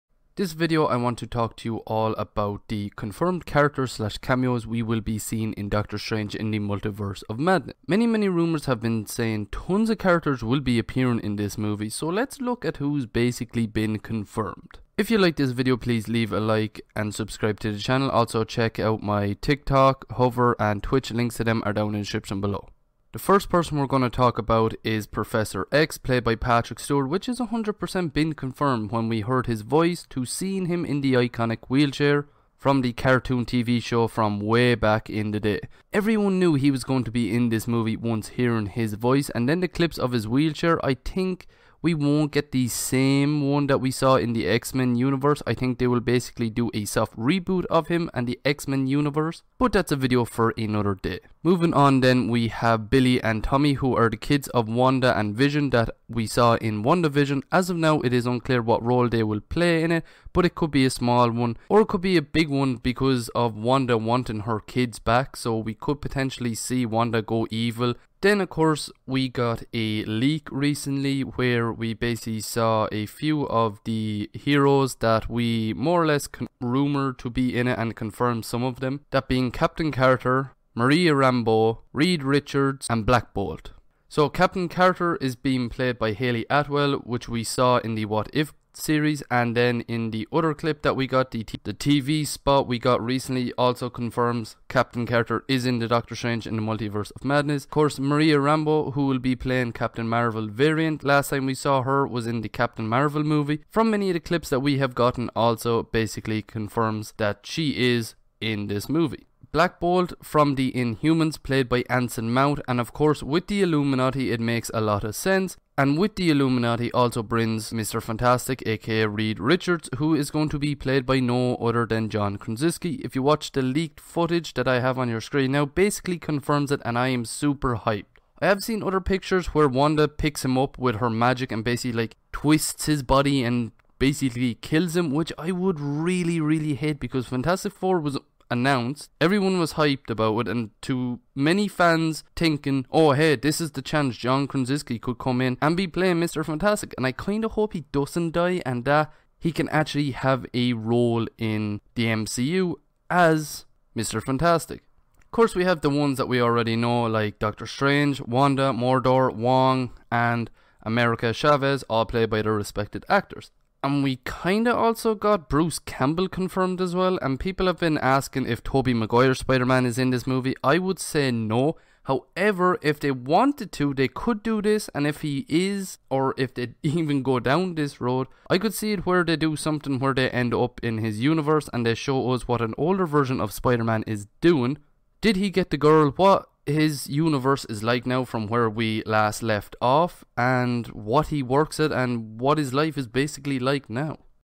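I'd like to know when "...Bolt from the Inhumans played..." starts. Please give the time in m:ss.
1:49.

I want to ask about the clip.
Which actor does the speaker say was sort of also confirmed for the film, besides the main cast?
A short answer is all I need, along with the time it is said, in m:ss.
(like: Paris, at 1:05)
Bruce Campbell, at 2:45.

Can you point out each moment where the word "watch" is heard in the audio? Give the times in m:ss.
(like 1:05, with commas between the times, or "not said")
2:03.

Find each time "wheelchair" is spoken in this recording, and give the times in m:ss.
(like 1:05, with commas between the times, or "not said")
0:31, 0:40.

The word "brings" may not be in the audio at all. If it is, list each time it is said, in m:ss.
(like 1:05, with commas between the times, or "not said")
1:57.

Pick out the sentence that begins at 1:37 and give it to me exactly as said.
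Of course Maria Rambeau who will be playing Captain Marvel variant last time we saw her was in the Captain Marvel movie.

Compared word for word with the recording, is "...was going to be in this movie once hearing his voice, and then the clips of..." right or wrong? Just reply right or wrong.
right.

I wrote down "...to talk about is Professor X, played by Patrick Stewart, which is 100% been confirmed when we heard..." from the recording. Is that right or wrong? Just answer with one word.
right.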